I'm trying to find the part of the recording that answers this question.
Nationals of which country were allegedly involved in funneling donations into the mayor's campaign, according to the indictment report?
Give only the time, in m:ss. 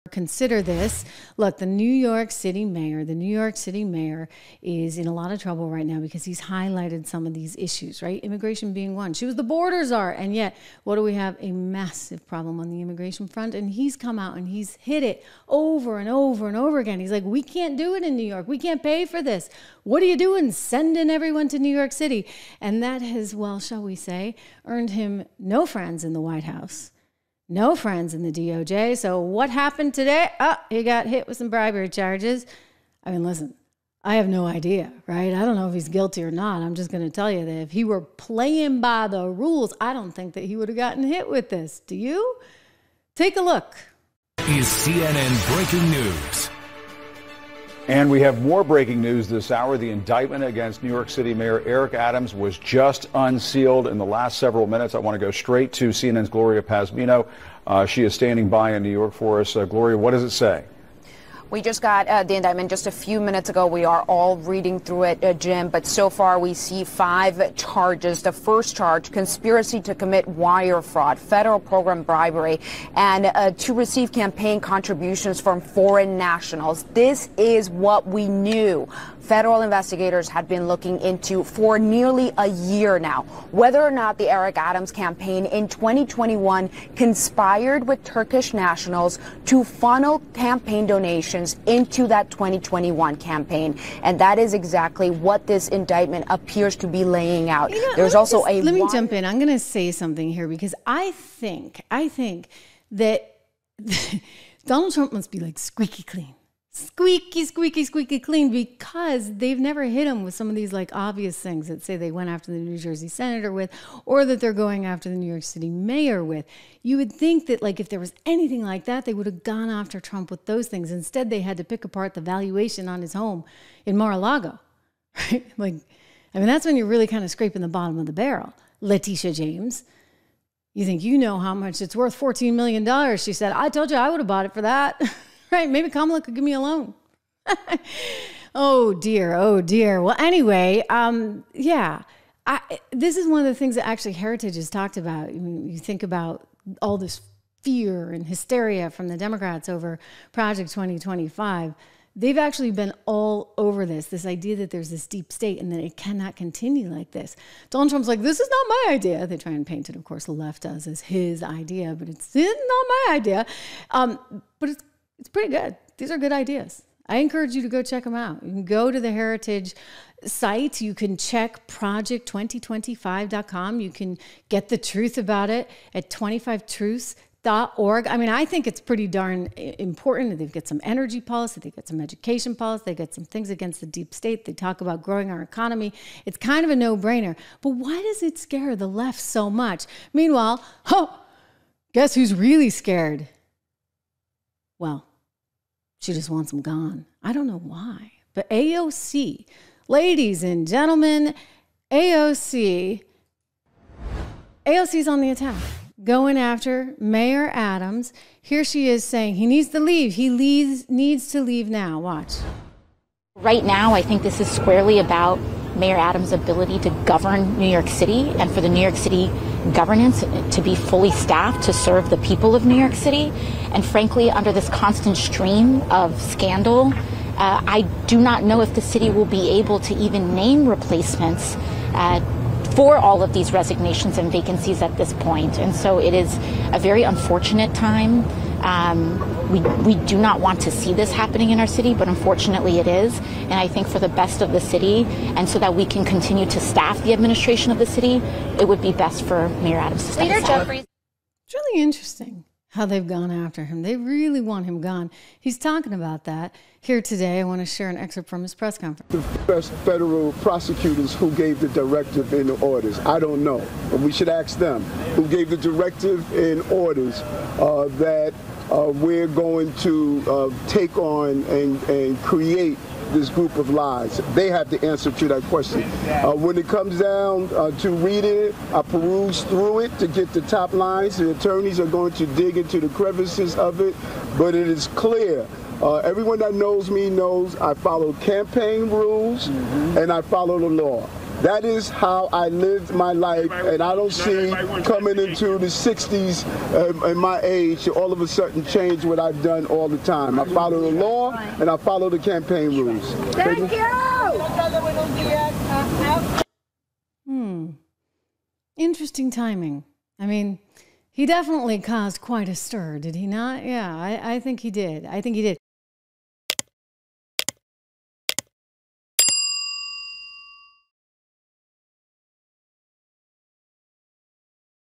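1:28.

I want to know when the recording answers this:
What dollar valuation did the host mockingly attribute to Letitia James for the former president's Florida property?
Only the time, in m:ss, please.
2:12.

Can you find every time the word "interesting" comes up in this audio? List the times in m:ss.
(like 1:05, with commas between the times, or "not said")
4:11, 5:08.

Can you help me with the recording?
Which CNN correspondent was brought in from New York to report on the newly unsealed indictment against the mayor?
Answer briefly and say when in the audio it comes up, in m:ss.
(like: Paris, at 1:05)
Gloria Pazmino, at 0:56.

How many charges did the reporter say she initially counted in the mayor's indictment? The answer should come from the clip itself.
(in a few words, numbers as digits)
5.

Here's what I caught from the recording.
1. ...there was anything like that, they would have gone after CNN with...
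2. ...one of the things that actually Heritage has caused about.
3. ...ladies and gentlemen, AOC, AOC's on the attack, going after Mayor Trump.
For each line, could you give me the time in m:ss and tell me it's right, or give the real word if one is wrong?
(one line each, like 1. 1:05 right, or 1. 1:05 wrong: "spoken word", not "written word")
1. 1:57 wrong: "Trump", not "CNN"
2. 2:23 wrong: "talked", not "caused"
3. 3:19 wrong: "Adams", not "Trump".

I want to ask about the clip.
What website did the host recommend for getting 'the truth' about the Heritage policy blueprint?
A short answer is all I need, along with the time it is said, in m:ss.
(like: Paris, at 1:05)
25truths.org, at 2:56.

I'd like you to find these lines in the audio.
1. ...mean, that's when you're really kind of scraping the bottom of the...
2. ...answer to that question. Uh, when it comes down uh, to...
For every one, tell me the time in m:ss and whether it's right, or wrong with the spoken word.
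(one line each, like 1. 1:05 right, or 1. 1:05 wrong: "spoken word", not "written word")
1. 2:06 right
2. 4:34 right.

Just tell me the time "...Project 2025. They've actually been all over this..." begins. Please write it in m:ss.
2:30.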